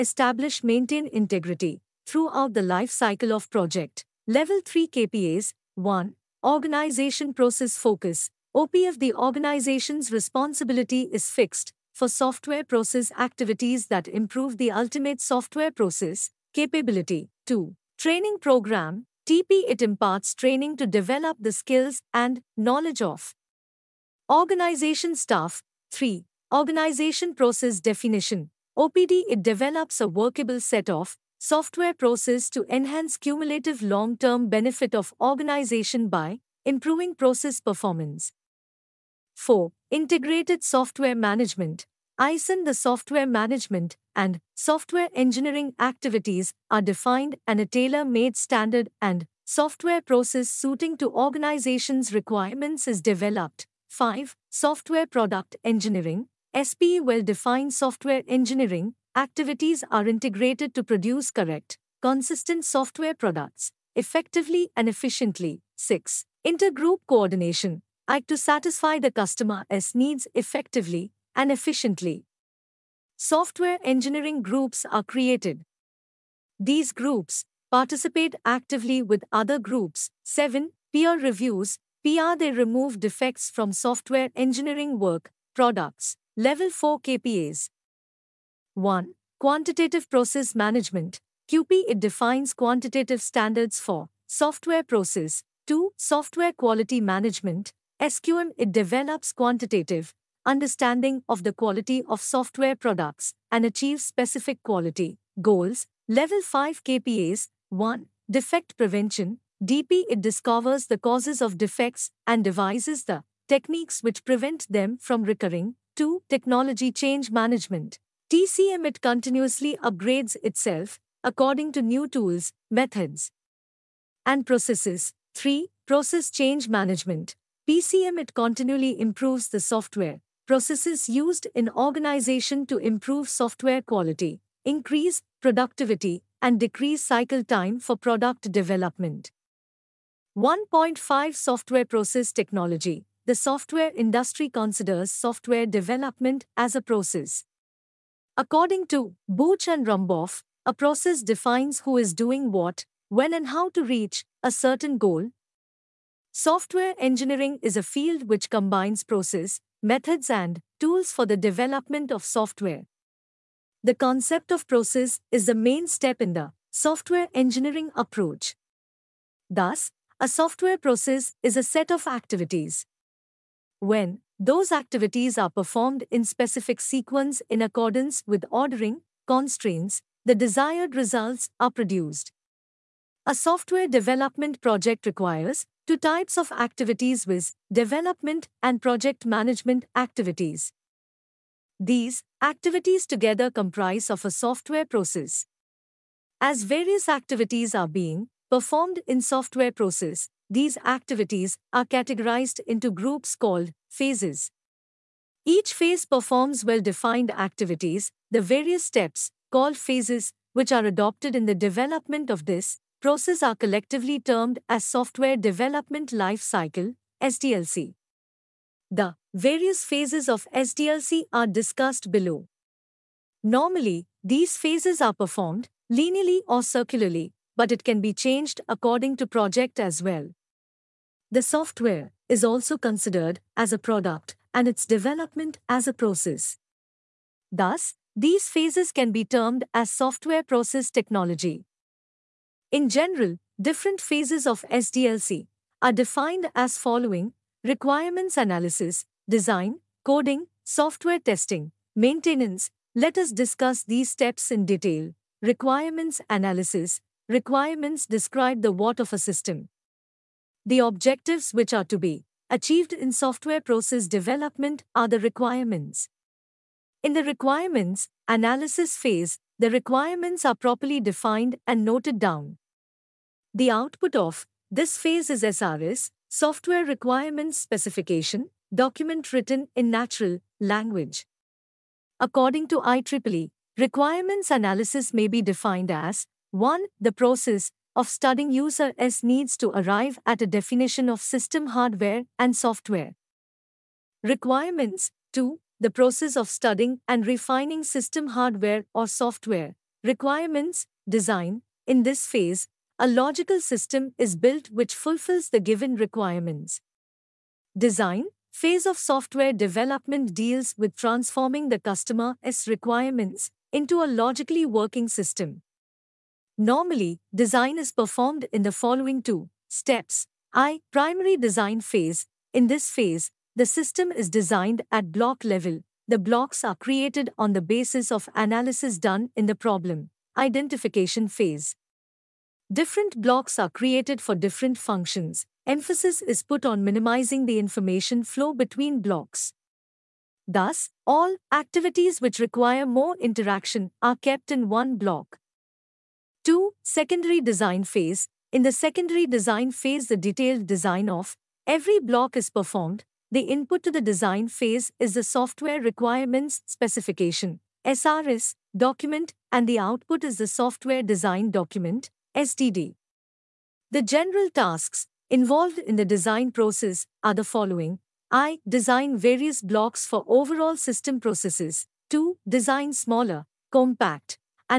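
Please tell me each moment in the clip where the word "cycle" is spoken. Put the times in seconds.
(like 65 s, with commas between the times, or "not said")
2 s, 137 s, 216 s.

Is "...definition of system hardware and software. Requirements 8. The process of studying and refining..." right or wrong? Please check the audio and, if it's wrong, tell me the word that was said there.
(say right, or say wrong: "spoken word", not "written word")
wrong: "2", not "8".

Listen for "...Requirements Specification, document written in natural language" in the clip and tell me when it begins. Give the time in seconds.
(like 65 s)
276 s.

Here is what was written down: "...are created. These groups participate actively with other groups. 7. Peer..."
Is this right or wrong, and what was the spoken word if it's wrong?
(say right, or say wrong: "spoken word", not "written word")
right.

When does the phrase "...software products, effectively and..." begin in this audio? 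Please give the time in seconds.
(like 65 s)
62 s.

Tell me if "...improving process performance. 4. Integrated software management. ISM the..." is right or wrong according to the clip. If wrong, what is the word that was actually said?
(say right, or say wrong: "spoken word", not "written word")
right.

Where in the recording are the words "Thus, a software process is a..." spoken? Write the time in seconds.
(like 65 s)
169 s.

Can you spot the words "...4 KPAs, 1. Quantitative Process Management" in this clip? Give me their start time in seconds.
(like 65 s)
86 s.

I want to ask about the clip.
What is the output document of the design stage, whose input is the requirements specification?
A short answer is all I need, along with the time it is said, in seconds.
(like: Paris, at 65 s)
Software design document (SDD), at 360 s.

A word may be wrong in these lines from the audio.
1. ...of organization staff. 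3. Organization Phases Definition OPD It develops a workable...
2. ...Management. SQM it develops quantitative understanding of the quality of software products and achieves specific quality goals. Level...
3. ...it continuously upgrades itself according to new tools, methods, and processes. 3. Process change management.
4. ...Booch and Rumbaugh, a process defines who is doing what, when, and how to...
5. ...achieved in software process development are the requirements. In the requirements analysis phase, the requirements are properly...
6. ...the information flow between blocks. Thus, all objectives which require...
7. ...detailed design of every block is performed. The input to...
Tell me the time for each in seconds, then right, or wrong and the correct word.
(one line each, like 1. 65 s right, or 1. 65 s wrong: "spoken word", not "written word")
1. 22 s wrong: "Process", not "Phases"
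2. 96 s right
3. 118 s right
4. 149 s right
5. 262 s right
6. 337 s wrong: "activities", not "objectives"
7. 350 s right.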